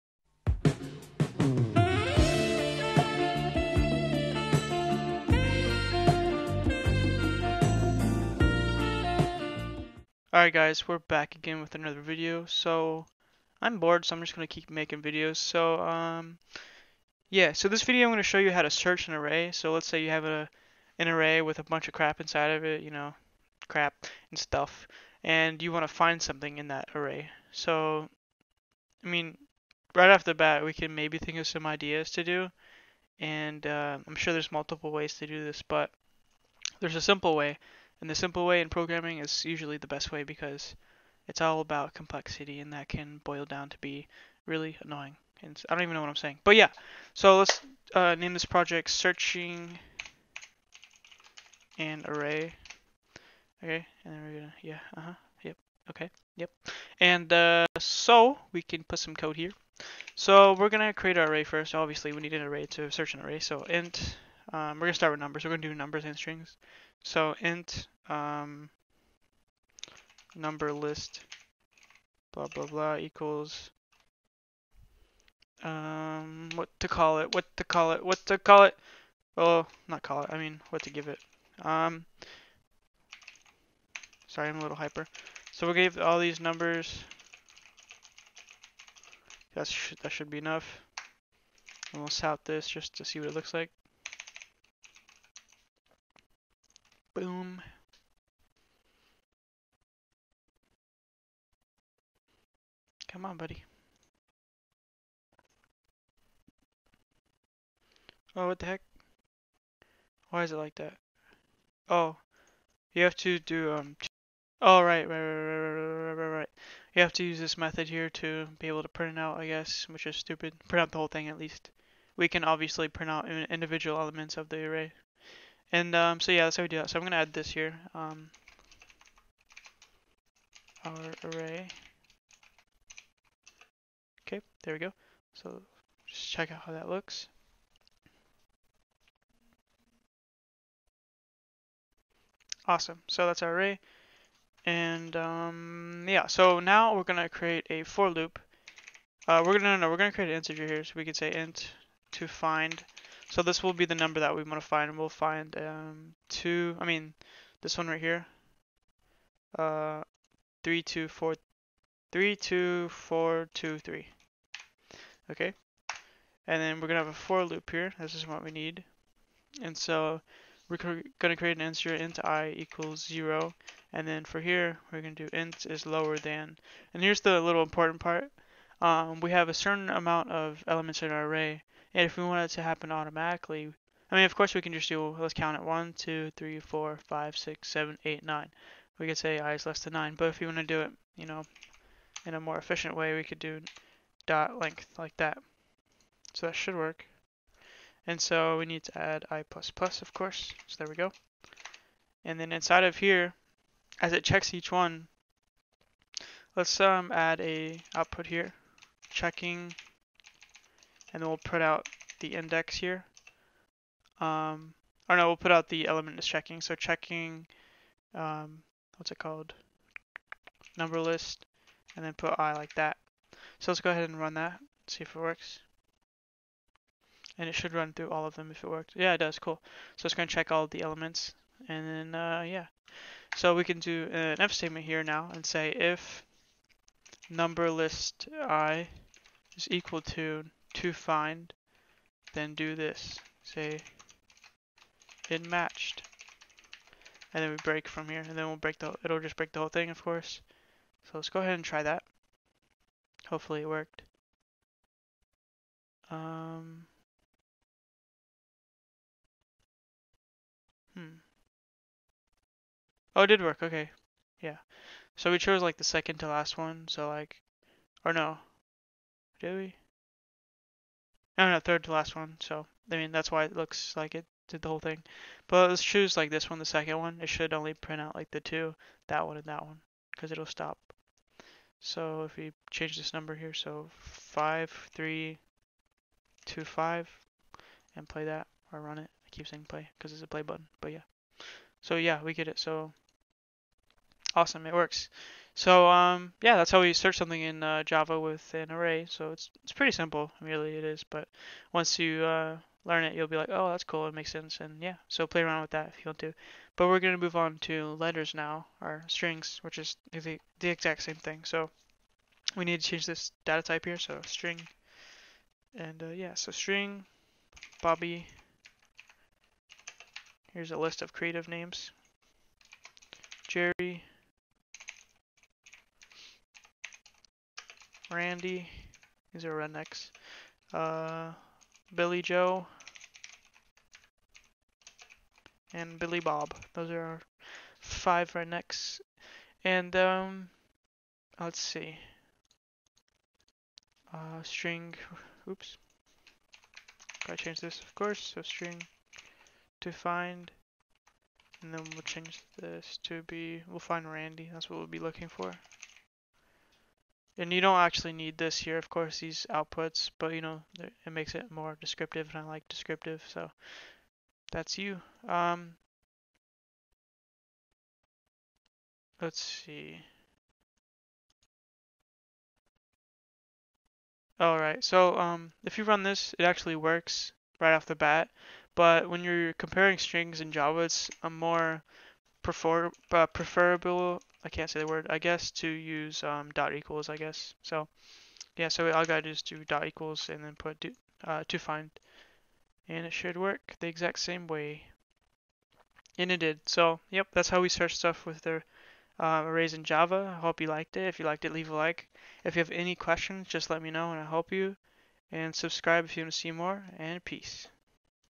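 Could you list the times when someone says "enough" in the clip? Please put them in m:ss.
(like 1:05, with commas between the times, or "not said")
1:30.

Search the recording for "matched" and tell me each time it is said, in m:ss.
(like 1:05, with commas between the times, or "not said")
4:05.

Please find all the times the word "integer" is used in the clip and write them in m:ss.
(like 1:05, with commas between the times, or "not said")
2:30, 2:51.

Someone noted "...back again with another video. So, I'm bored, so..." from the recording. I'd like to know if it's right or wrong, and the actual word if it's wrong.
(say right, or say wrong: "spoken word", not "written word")
right.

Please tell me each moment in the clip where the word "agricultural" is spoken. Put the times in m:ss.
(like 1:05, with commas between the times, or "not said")
not said.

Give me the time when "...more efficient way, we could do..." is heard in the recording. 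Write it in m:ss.
3:12.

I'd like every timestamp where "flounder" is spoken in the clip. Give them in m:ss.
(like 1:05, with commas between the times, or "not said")
not said.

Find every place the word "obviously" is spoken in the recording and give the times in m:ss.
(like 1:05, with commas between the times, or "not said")
1:01, 2:02.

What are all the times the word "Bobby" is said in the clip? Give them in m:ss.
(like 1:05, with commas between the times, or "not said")
5:17.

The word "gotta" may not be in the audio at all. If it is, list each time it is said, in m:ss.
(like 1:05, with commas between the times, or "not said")
5:47, 6:29.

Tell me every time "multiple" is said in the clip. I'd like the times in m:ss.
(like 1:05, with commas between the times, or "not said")
0:34.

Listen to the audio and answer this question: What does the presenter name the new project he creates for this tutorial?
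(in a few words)
searching an array.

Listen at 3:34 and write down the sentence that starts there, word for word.
Um, or no, we'll put out the element is checking.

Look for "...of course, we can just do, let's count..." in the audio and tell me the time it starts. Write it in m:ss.
3:04.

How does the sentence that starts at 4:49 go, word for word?
I keep saying play because it's a play button, but yeah.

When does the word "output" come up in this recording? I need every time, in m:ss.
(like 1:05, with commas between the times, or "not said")
3:27, 5:59.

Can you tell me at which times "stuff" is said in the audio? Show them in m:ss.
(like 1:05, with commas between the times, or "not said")
0:24, 6:37.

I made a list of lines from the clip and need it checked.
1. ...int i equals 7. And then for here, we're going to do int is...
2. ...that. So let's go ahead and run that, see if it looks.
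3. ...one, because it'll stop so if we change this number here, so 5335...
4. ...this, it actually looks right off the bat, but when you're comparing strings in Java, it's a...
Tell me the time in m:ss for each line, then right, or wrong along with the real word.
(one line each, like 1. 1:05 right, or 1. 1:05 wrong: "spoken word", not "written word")
1. 2:51 wrong: "0", not "7"
2. 3:42 wrong: "works", not "looks"
3. 4:39 wrong: "5325", not "5335"
4. 6:16 wrong: "works", not "looks".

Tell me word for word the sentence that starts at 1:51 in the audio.
Oh, you have to do, um, oh, right, right, right, right, right, right.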